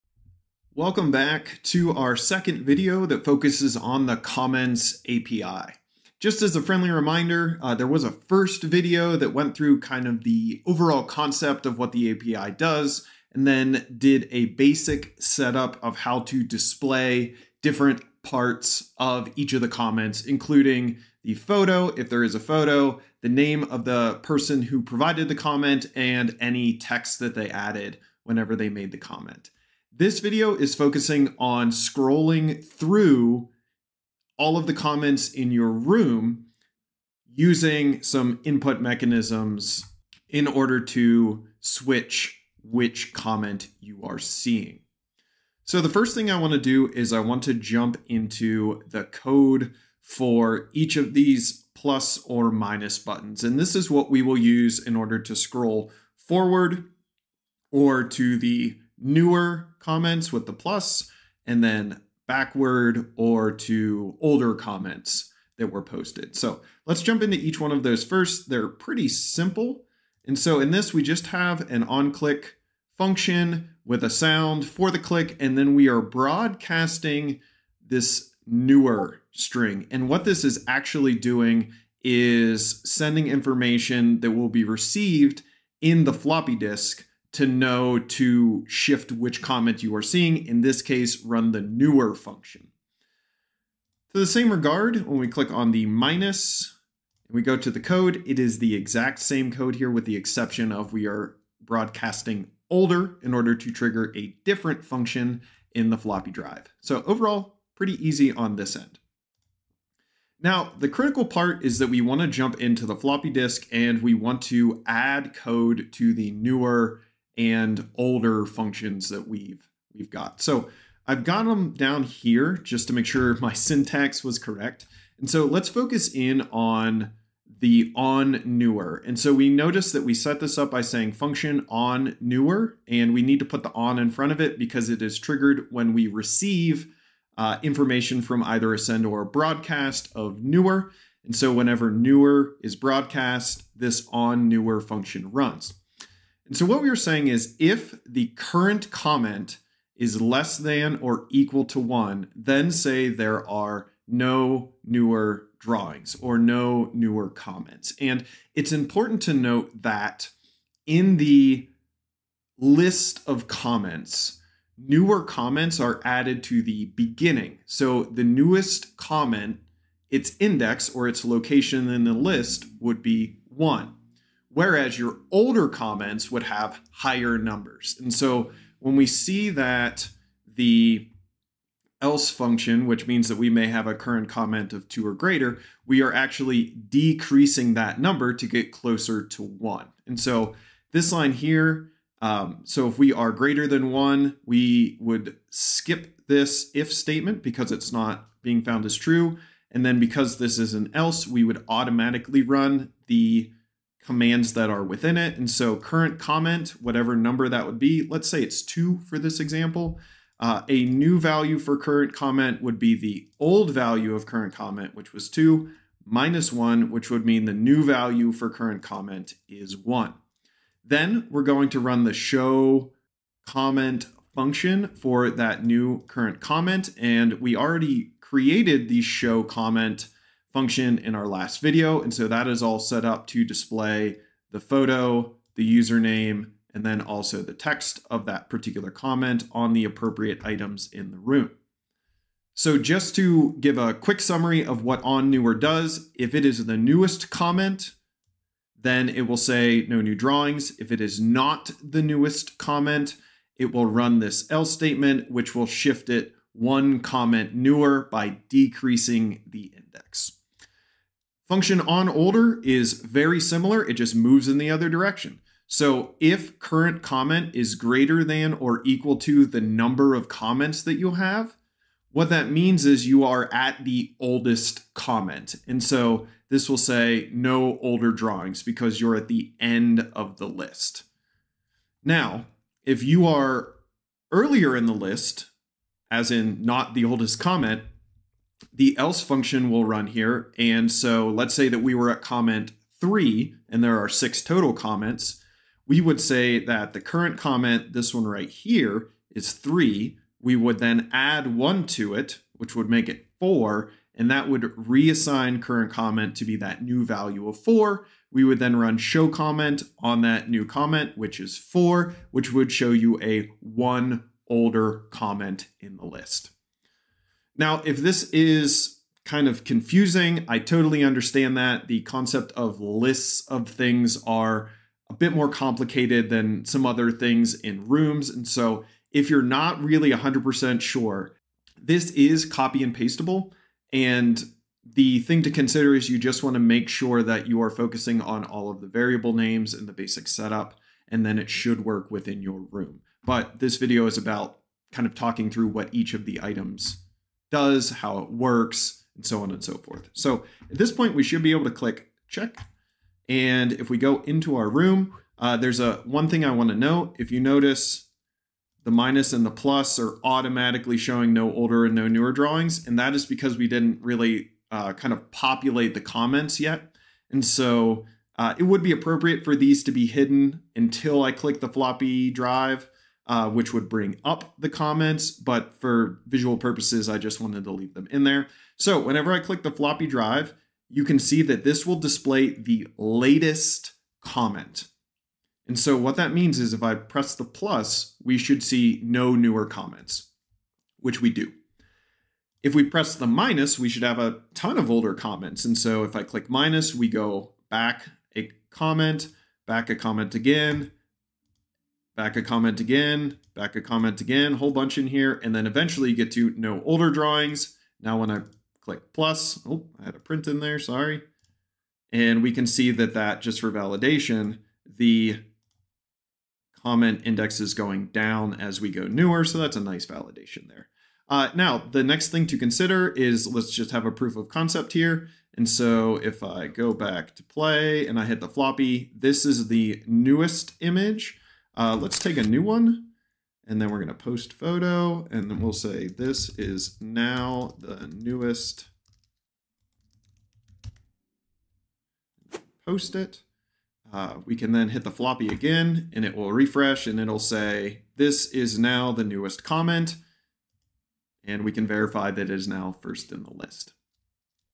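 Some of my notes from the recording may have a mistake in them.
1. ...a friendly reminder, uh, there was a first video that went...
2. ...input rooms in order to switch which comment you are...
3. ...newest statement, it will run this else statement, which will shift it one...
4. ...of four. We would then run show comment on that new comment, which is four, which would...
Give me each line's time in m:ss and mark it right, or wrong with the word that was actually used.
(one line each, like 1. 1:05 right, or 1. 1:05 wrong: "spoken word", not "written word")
1. 0:06 right
2. 0:38 wrong: "mechanisms", not "rooms"
3. 4:12 wrong: "comment", not "statement"
4. 5:07 right.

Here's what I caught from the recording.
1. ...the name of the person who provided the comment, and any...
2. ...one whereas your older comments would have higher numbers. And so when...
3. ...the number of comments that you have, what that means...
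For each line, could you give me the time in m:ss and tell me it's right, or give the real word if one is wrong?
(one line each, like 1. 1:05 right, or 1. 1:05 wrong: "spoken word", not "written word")
1. 0:23 right
2. 2:53 right
3. 4:29 right.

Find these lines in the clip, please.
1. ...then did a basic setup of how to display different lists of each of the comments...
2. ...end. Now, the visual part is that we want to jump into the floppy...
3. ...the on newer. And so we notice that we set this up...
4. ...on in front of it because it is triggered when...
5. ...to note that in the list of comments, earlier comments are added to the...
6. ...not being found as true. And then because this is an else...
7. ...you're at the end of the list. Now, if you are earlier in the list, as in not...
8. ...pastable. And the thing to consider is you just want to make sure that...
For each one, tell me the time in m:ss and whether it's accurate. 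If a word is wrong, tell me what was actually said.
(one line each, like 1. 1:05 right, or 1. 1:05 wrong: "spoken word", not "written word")
1. 0:13 wrong: "parts", not "lists"
2. 1:48 wrong: "critical", not "visual"
3. 2:07 right
4. 2:13 right
5. 2:39 wrong: "newer", not "earlier"
6. 3:17 right
7. 4:39 right
8. 5:32 right.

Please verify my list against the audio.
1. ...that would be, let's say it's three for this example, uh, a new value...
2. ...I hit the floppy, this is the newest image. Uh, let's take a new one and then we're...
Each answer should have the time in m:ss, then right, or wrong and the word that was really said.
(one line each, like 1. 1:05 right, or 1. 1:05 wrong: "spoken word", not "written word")
1. 3:27 wrong: "two", not "three"
2. 7:08 right.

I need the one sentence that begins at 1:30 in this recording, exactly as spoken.
In this case, run the newer function.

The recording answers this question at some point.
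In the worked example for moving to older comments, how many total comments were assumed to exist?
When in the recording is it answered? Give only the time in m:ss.
4:54.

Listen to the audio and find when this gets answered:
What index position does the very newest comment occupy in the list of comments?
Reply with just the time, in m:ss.
2:50.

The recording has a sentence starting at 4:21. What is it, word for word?
Function on older is very similar, it just moves in the other direction.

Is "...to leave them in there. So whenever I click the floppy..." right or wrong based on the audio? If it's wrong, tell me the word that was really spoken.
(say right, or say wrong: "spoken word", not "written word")
right.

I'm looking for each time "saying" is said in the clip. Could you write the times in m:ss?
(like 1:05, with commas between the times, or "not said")
2:10, 2:26.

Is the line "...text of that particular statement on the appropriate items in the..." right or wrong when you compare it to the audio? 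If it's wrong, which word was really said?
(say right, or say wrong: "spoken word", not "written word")
wrong: "comment", not "statement".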